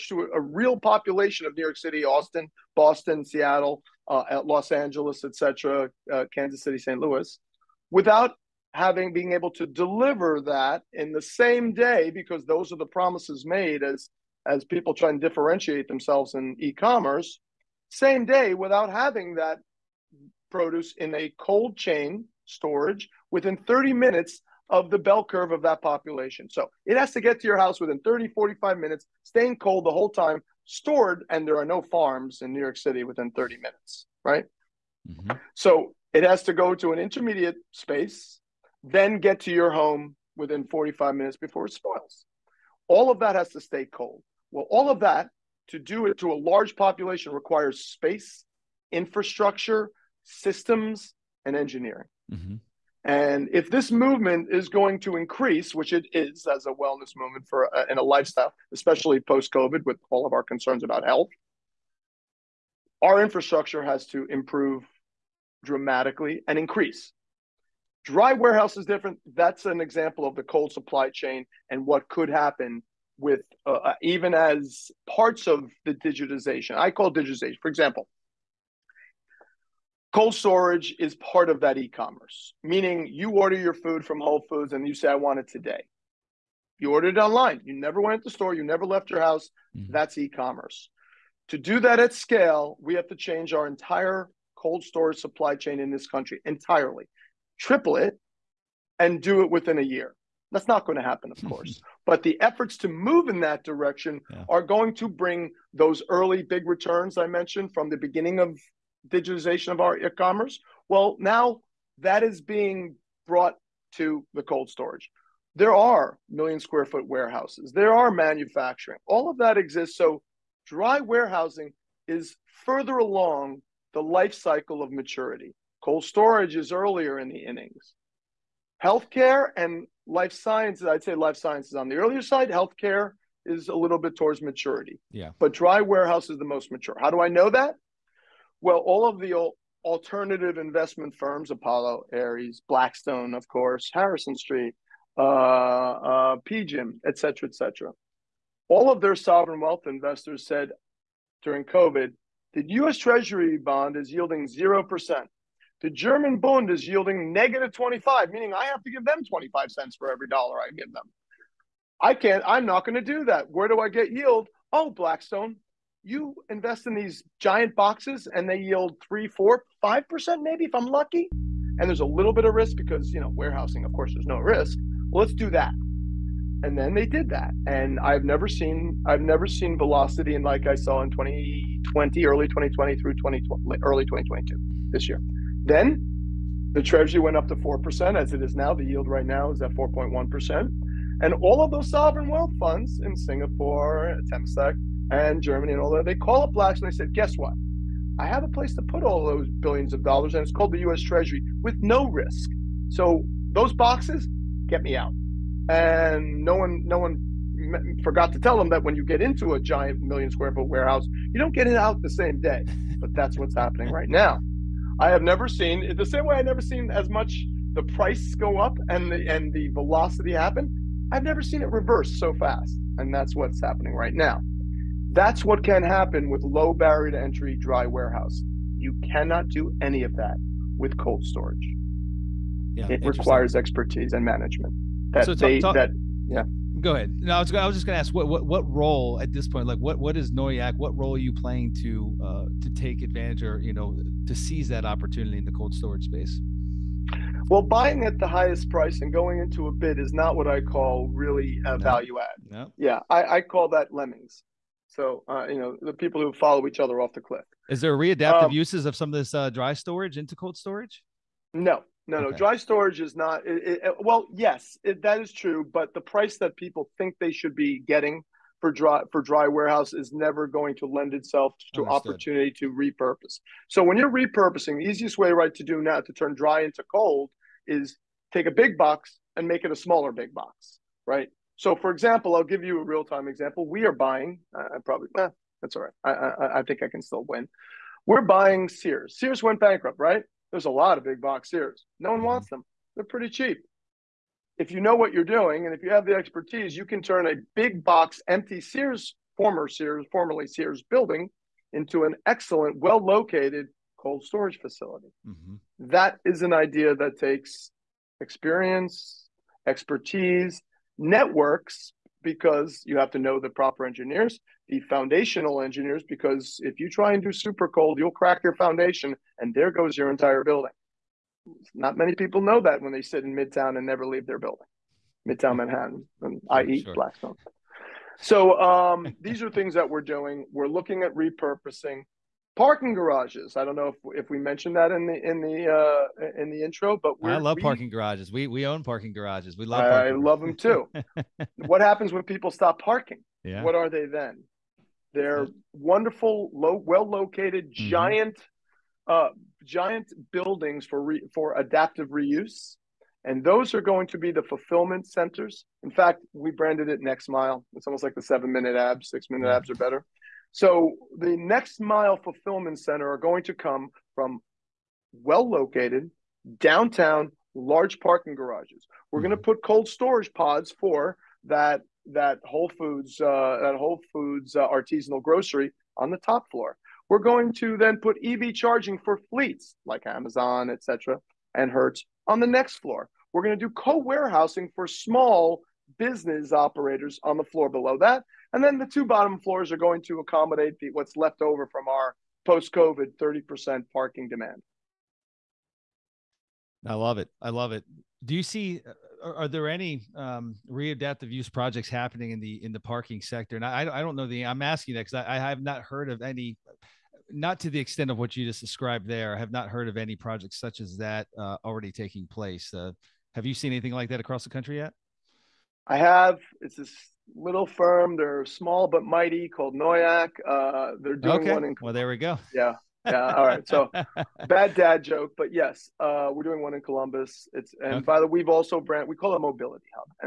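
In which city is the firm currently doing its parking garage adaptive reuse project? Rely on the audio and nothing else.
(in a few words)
Columbus.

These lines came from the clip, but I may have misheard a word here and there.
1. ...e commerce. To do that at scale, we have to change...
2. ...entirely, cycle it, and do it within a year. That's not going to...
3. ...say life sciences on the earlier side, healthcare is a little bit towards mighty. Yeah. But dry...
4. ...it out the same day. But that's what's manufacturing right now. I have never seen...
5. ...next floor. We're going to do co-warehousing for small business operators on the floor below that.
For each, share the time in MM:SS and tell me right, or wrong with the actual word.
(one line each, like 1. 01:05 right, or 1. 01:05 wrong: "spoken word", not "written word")
1. 01:30 right
2. 01:36 wrong: "triple", not "cycle"
3. 02:11 wrong: "maturity", not "mighty"
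4. 03:31 wrong: "happening", not "manufacturing"
5. 06:22 right.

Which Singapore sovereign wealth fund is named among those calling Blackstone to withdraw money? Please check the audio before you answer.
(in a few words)
Temasek.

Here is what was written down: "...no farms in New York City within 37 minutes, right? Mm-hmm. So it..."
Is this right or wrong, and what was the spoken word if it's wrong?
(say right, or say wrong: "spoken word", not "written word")
wrong: "30", not "37".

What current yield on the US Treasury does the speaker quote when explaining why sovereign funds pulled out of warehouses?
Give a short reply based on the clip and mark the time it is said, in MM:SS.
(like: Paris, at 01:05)
4.1%, at 03:09.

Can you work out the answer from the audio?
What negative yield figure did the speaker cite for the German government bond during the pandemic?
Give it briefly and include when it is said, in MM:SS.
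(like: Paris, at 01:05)
negative 25, at 02:37.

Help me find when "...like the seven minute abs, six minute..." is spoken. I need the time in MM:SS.
05:58.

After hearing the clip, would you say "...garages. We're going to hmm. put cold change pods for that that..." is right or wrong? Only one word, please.
wrong.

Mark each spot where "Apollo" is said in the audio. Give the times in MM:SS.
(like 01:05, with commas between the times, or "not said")
02:21.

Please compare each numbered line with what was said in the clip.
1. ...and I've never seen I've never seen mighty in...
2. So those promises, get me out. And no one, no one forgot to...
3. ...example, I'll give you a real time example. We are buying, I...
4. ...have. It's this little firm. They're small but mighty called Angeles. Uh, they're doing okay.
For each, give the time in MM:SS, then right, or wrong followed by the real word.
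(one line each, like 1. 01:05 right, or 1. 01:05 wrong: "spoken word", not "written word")
1. 02:57 wrong: "velocity", not "mighty"
2. 03:22 wrong: "boxes", not "promises"
3. 04:41 right
4. 06:55 wrong: "Noyack", not "Angeles".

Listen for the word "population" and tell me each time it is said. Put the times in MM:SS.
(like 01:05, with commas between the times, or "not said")
00:00, 00:25, 00:46.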